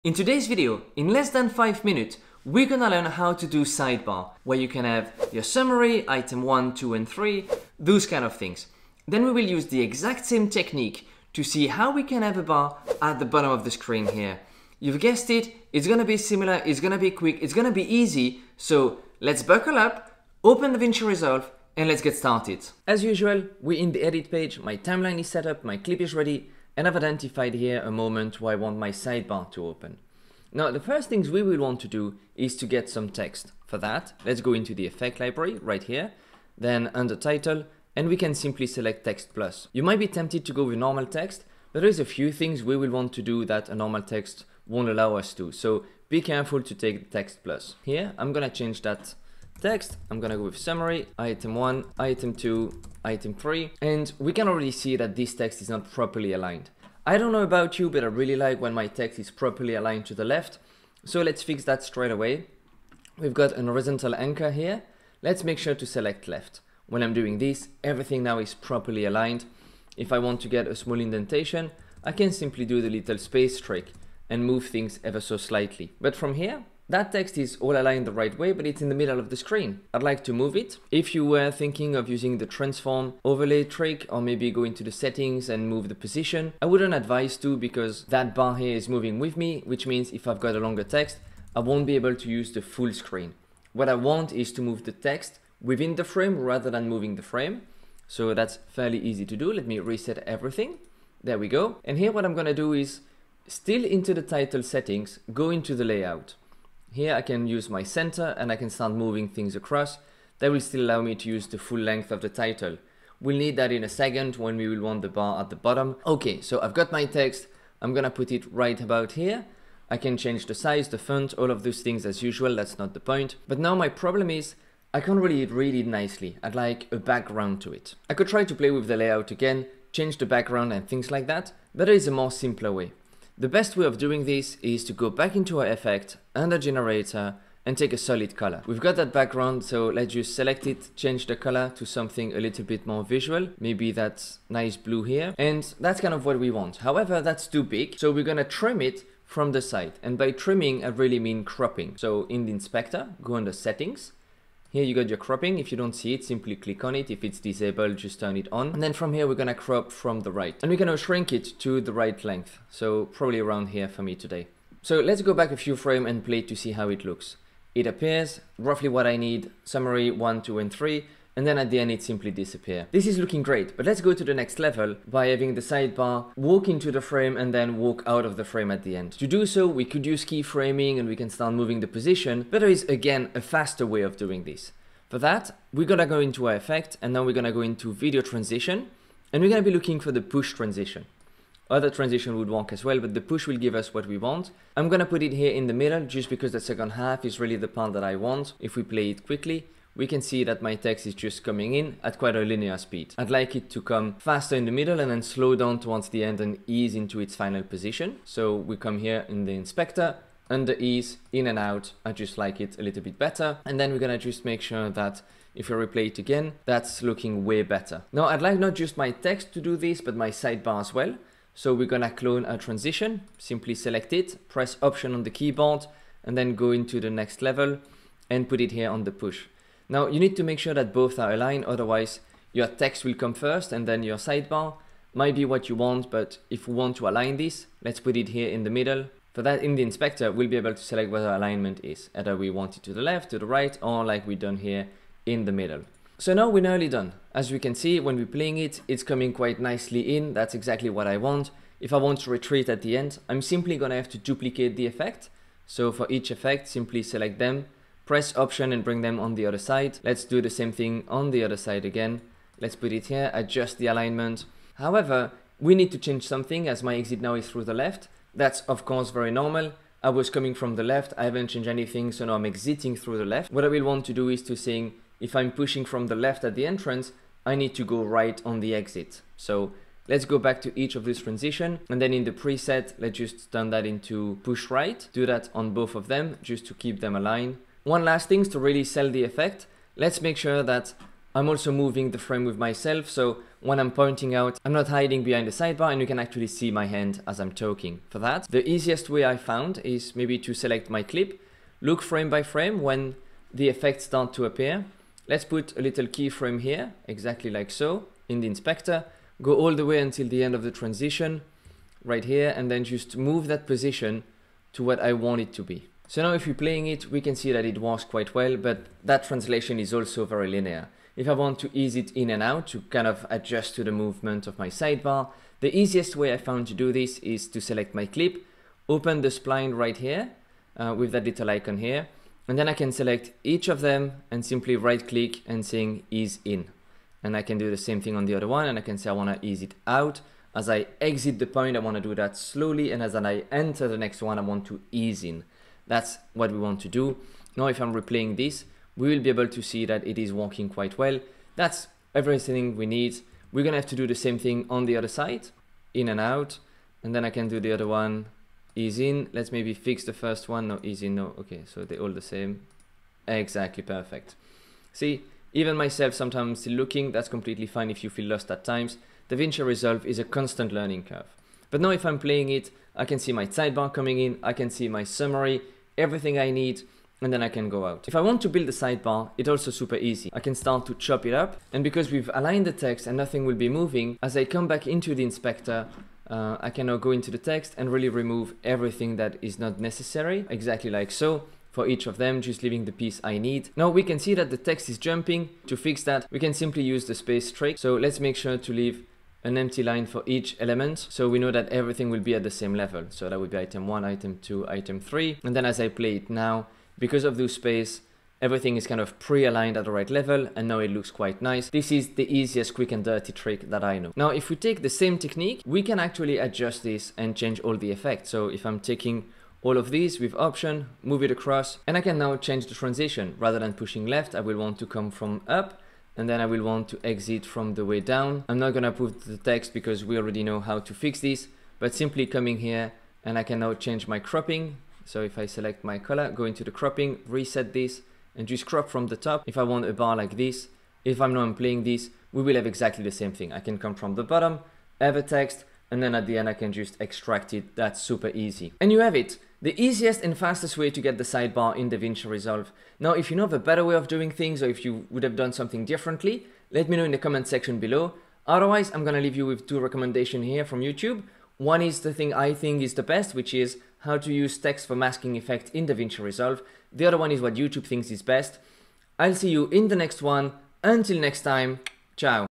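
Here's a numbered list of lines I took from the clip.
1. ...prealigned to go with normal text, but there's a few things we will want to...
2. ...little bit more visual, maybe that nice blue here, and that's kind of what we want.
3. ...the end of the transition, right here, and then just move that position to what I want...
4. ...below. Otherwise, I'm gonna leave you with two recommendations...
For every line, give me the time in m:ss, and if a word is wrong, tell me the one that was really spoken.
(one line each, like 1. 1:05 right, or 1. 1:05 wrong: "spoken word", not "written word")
1. 0:40 wrong: "tempted", not "prealigned"
2. 2:22 right
3. 5:10 right
4. 7:37 right.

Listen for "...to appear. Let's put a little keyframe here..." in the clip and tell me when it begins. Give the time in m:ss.
5:04.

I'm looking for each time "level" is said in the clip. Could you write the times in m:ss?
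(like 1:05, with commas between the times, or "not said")
2:54, 3:47, 6:42, 6:50.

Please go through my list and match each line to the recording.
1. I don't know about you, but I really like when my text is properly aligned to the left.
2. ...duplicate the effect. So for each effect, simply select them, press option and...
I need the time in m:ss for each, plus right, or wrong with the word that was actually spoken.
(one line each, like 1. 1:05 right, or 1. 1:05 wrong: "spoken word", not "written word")
1. 0:57 right
2. 4:14 right.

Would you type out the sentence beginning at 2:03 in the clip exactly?
But now my problem is, I can't really read it nicely.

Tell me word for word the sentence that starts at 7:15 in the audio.
So if I select my color, go into the cropping, reset this and just crop from the top.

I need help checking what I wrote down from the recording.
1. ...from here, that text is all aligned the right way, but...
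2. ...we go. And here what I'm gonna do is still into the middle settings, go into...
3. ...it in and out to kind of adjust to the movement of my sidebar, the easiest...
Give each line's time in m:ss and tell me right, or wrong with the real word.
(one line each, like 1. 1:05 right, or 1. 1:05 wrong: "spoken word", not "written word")
1. 1:16 right
2. 1:41 wrong: "title", not "middle"
3. 5:21 right.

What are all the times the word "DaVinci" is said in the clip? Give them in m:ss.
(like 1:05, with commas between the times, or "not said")
0:20, 6:09, 7:31, 7:45.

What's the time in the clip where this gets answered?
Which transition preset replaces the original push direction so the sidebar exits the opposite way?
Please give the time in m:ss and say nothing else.
4:44.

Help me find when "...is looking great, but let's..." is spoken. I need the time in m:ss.
2:53.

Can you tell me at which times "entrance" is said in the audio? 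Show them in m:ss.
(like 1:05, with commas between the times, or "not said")
4:36.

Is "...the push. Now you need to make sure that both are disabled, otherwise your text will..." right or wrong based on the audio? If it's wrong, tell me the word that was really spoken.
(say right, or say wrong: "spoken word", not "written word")
wrong: "aligned", not "disabled".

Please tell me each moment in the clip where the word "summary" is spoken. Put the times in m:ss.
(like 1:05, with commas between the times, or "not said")
0:05, 0:50, 2:49, 6:15.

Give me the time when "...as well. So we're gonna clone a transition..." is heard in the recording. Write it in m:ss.
3:40.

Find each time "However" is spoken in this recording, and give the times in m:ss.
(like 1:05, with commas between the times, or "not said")
2:26, 4:24.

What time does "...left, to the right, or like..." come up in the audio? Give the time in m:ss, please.
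4:03.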